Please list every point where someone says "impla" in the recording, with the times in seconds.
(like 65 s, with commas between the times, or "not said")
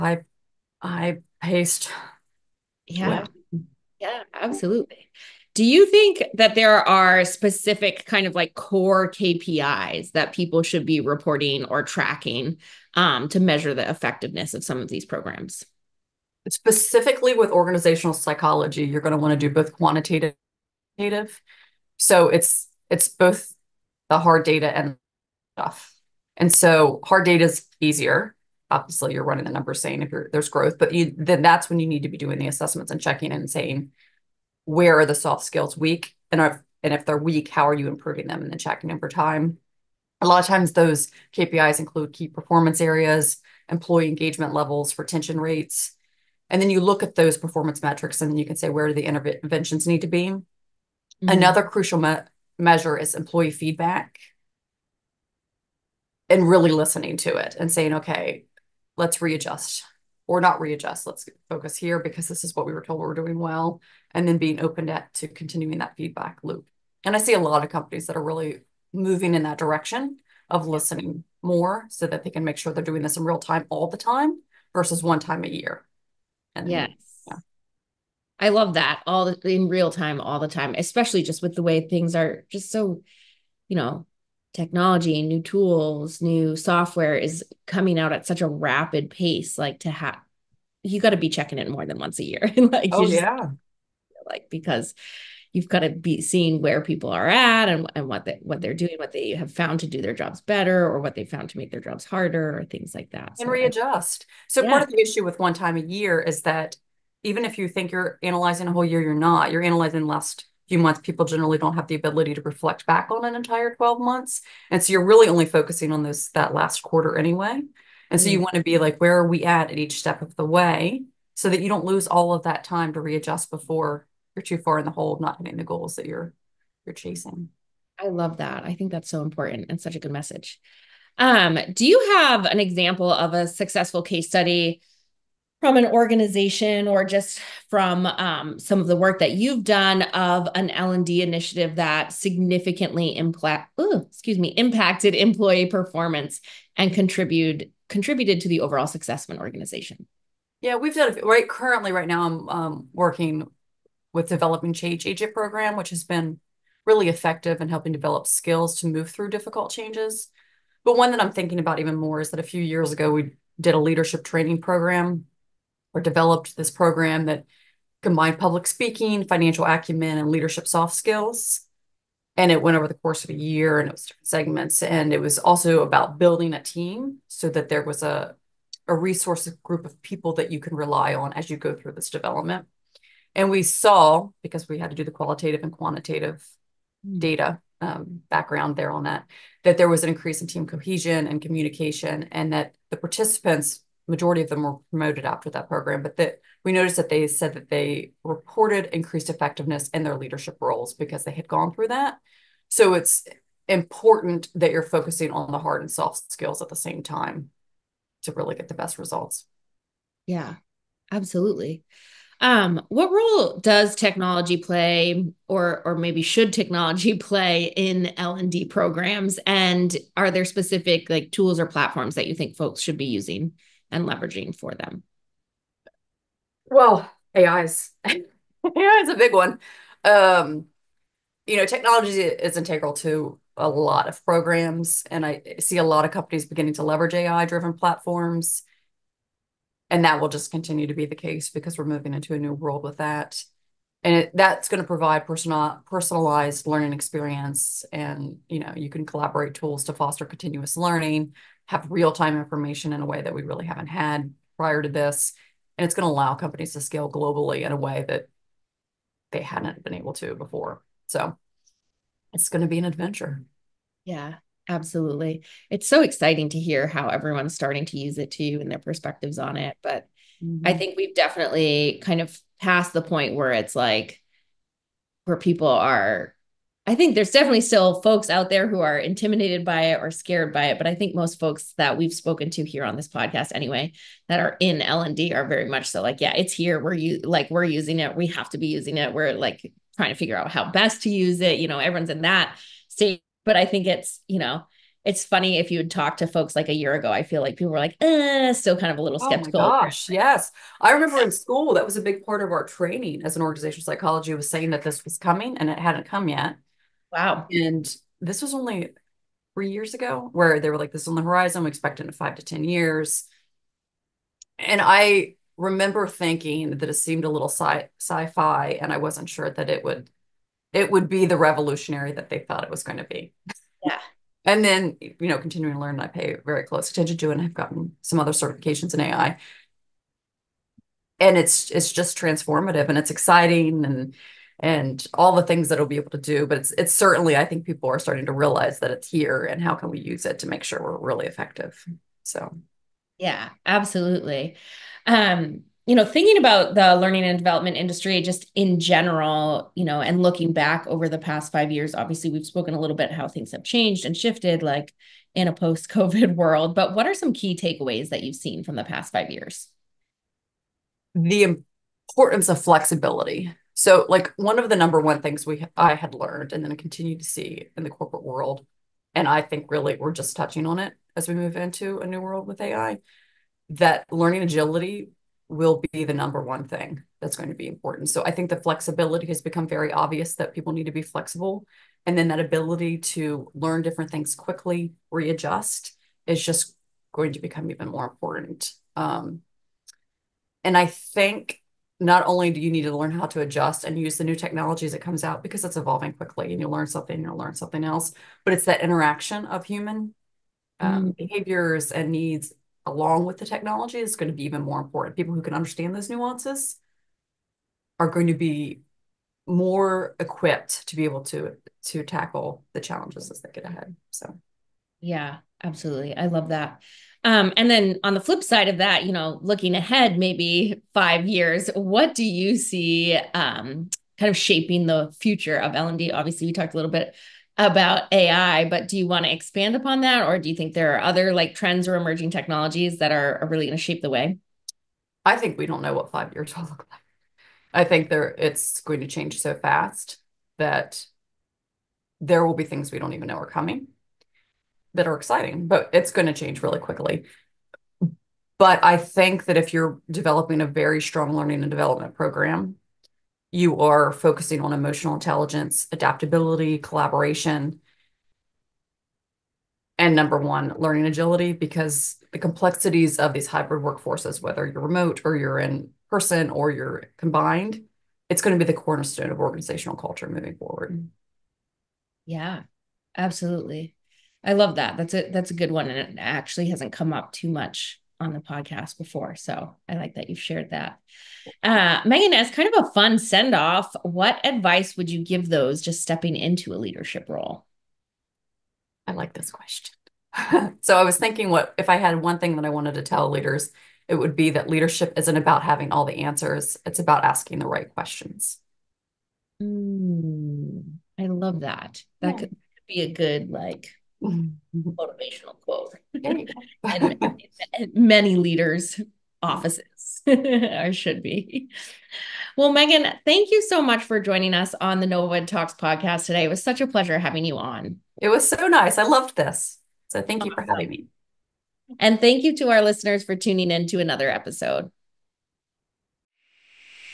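143 s.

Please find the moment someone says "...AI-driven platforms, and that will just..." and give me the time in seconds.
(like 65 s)
237 s.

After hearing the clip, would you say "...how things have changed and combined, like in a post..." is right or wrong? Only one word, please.
wrong.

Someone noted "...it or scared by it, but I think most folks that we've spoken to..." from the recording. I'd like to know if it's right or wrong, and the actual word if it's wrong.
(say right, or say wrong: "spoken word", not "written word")
right.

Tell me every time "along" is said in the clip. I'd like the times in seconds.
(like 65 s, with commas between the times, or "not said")
402 s.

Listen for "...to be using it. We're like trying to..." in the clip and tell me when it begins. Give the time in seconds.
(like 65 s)
288 s.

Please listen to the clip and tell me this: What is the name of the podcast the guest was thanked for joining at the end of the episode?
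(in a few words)
NovoEd Talks.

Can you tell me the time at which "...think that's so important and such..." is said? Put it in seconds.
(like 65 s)
128 s.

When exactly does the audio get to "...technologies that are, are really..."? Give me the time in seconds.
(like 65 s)
432 s.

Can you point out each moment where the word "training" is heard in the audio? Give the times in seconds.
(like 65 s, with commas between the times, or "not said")
164 s, 302 s.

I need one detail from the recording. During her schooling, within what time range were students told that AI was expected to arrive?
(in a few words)
5 to 10 years.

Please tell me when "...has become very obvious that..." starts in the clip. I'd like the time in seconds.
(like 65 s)
379 s.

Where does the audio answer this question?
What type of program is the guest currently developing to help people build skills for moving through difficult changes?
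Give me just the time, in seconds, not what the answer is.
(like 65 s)
154 s.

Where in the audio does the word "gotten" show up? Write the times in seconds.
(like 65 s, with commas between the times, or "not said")
327 s.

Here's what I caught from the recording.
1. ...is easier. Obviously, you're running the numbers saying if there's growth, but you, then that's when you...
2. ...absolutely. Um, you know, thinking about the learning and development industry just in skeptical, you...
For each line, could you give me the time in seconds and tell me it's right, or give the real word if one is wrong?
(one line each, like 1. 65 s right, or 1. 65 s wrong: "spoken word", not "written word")
1. 27 s right
2. 343 s wrong: "general", not "skeptical".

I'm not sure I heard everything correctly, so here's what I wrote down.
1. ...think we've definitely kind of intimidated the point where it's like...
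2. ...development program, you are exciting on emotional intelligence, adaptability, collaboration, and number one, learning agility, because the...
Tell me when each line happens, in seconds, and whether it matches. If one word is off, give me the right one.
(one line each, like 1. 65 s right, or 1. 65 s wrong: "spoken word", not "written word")
1. 270 s wrong: "passed", not "intimidated"
2. 451 s wrong: "focusing", not "exciting".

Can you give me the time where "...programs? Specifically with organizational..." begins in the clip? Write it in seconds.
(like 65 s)
15 s.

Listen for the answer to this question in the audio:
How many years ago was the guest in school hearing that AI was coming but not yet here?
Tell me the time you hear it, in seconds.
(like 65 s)
309 s.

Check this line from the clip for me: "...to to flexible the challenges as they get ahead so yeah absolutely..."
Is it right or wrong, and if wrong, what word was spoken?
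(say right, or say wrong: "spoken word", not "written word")
wrong: "tackle", not "flexible".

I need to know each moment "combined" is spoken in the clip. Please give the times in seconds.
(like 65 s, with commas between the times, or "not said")
168 s, 467 s.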